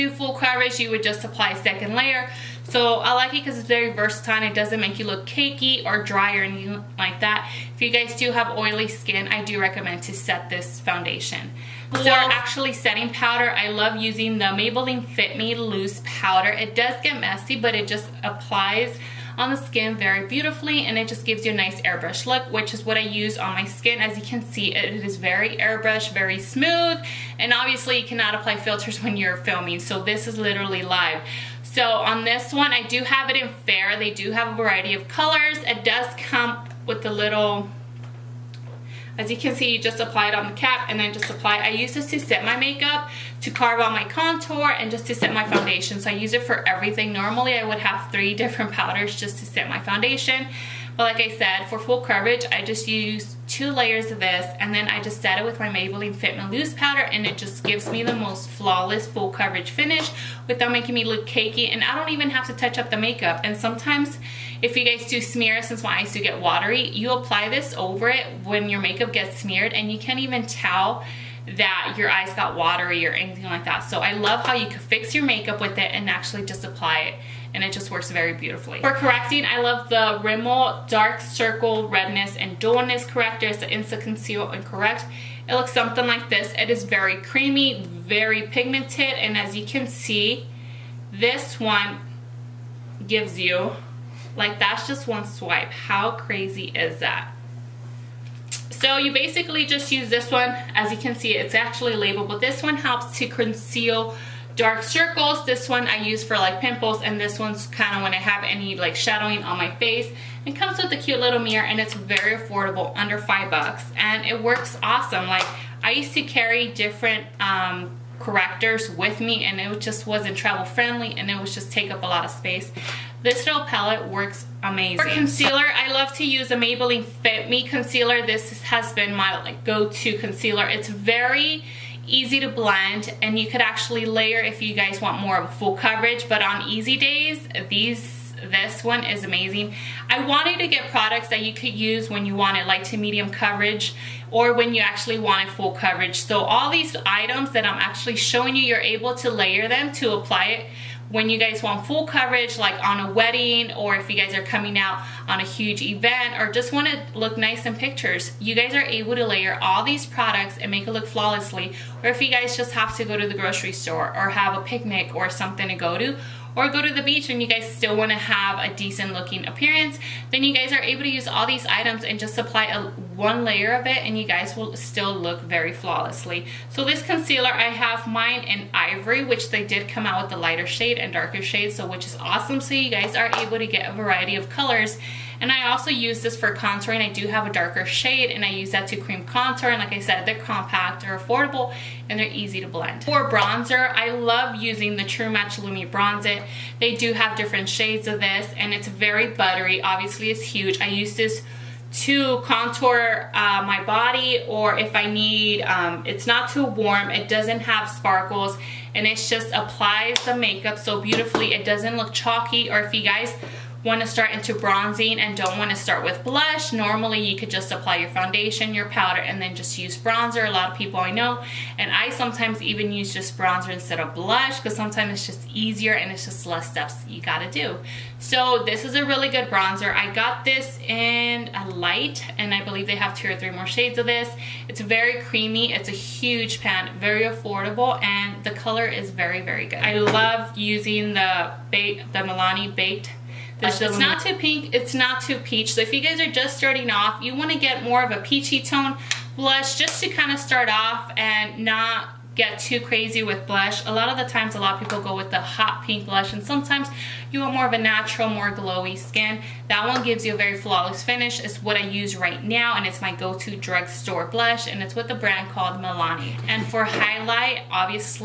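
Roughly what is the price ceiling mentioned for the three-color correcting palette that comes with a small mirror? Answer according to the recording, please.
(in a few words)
under 5 dollars.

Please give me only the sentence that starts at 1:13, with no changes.
So I love how you can fix your makeup with it and actually just apply it and it just works very beautifully.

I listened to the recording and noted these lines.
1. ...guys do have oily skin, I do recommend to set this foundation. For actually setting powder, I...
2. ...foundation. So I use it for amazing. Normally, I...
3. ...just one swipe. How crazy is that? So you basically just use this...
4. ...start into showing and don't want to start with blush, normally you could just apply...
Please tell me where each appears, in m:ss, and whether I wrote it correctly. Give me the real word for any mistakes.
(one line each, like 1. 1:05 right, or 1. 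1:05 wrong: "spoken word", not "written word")
1. 0:07 right
2. 0:45 wrong: "everything", not "amazing"
3. 1:34 right
4. 3:34 wrong: "bronzing", not "showing".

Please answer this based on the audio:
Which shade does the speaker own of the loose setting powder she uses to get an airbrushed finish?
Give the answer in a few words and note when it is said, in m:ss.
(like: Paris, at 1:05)
Fair, at 0:33.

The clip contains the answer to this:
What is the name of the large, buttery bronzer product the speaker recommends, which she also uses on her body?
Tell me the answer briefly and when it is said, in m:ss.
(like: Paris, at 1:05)
True Match Lumi Bronze It, at 3:15.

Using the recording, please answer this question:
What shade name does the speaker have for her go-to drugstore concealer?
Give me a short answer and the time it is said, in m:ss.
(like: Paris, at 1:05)
Ivory, at 2:58.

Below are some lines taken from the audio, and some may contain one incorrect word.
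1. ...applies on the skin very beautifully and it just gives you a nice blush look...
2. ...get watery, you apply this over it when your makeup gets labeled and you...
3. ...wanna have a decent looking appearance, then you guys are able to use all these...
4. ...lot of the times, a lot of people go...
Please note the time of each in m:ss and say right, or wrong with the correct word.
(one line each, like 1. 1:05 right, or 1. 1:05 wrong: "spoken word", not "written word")
1. 0:18 wrong: "airbrush", not "blush"
2. 1:06 wrong: "smeared", not "labeled"
3. 2:47 right
4. 4:13 right.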